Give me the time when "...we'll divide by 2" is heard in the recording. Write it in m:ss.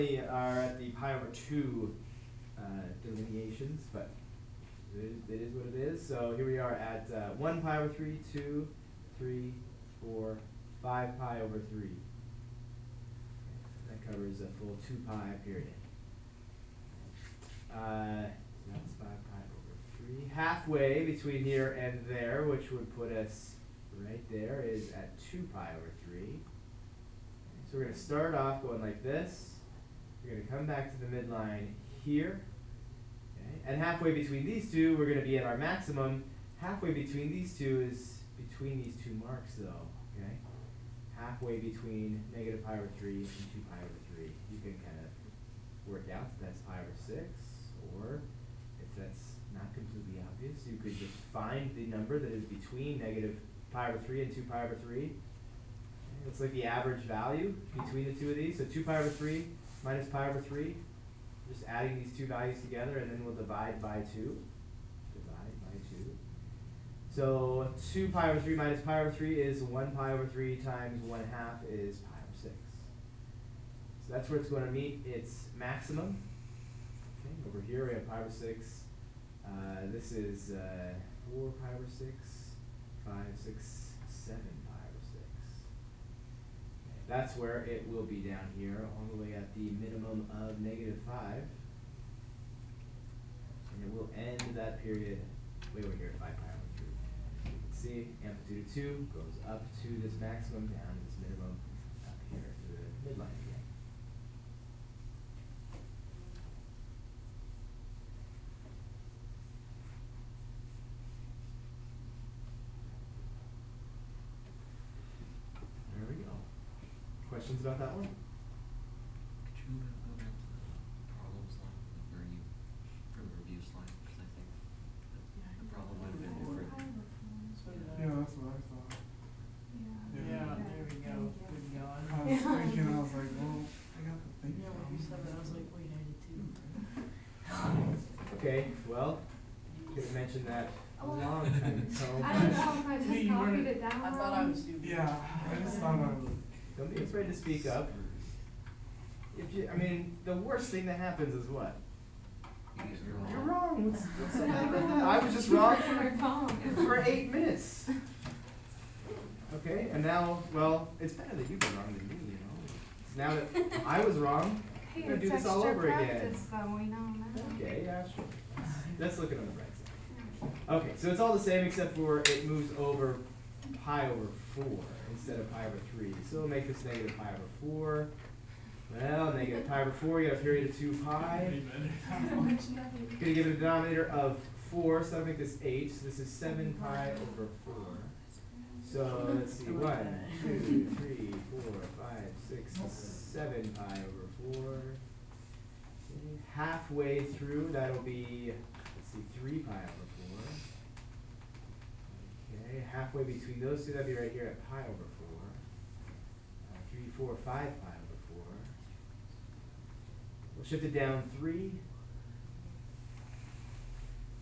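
1:03.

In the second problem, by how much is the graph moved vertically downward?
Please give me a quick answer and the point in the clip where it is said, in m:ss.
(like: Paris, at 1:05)
3, at 3:30.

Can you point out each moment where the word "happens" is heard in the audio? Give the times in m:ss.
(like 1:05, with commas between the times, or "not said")
2:30.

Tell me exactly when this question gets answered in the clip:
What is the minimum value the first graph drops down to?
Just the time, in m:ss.
1:30.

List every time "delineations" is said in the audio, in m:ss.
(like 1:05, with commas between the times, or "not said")
0:03.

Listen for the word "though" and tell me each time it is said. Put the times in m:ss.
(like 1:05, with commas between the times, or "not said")
0:39, 2:46.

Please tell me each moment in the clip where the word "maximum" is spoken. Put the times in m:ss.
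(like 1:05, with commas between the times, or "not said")
0:35, 1:15, 1:40.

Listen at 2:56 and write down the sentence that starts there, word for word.
So we'll make this negative pi over 4.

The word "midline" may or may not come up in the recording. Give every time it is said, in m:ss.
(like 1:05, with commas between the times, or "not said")
0:31, 1:43.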